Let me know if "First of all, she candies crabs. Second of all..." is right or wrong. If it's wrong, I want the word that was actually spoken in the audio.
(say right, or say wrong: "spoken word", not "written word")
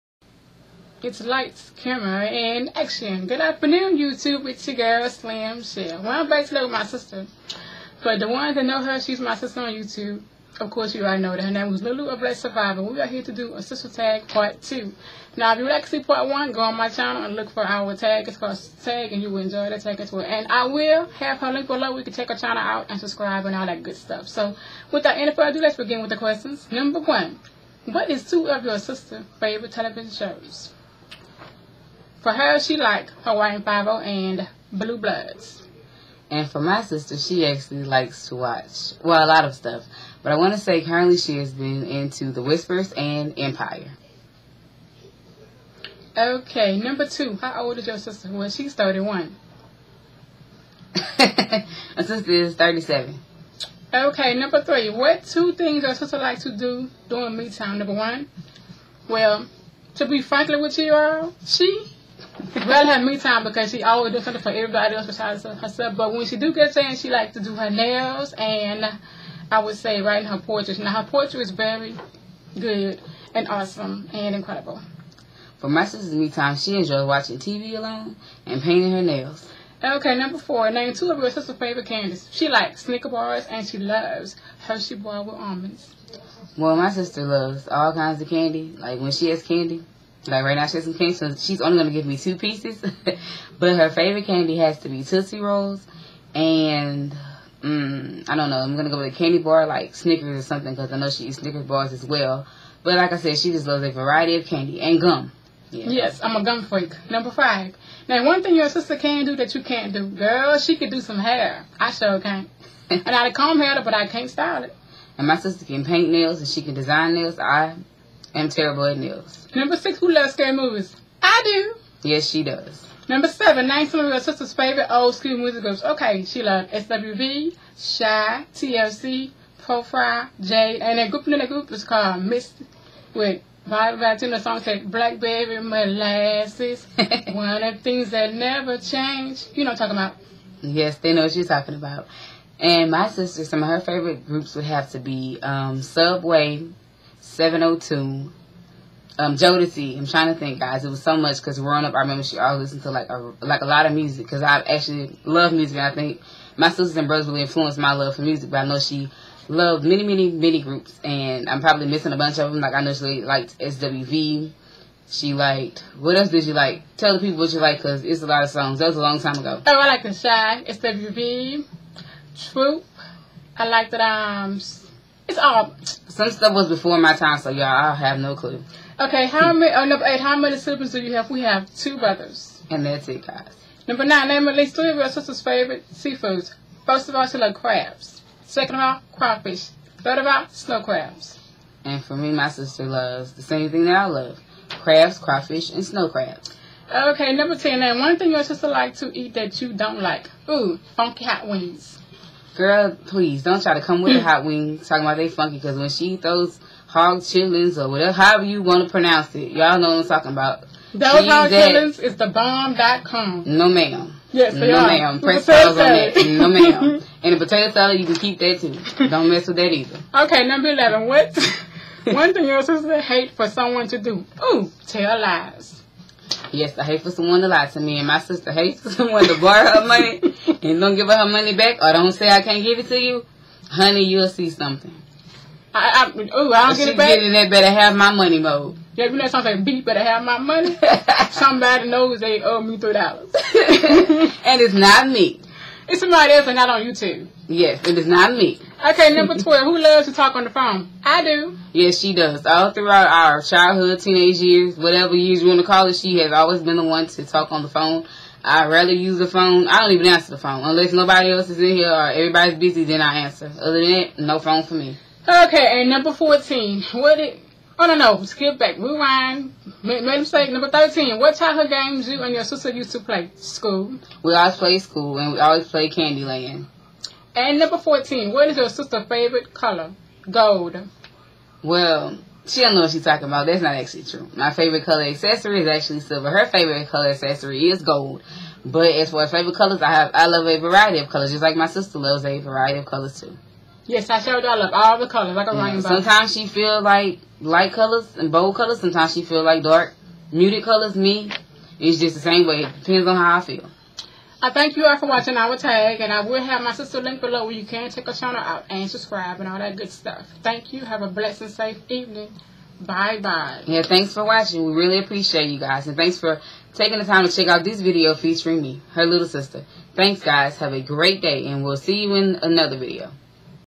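wrong: "loves", not "candies".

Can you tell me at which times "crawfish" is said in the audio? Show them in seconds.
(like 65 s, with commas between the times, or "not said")
189 s, 195 s.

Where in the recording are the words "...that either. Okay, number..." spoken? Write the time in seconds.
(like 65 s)
219 s.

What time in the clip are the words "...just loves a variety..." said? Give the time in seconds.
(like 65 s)
103 s.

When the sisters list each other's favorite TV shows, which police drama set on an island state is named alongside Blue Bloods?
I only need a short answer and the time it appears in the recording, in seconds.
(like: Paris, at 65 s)
Hawaiian Five-O, at 33 s.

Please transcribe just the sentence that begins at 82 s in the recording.
She likes Snicker bars and she loves Hershey bar with almonds.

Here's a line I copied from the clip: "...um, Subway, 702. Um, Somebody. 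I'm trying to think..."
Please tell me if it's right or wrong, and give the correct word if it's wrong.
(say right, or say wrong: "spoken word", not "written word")
wrong: "Jodeci", not "Somebody".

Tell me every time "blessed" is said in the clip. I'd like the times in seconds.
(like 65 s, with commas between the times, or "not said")
12 s, 311 s.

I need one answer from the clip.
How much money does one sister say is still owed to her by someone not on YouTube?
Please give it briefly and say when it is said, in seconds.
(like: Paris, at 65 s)
3 dollars, at 242 s.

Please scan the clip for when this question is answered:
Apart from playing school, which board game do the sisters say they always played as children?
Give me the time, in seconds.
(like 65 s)
275 s.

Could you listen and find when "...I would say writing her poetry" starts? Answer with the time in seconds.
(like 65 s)
69 s.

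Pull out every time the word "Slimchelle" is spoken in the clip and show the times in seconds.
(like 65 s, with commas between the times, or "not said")
5 s.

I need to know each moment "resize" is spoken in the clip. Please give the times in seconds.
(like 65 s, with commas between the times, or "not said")
not said.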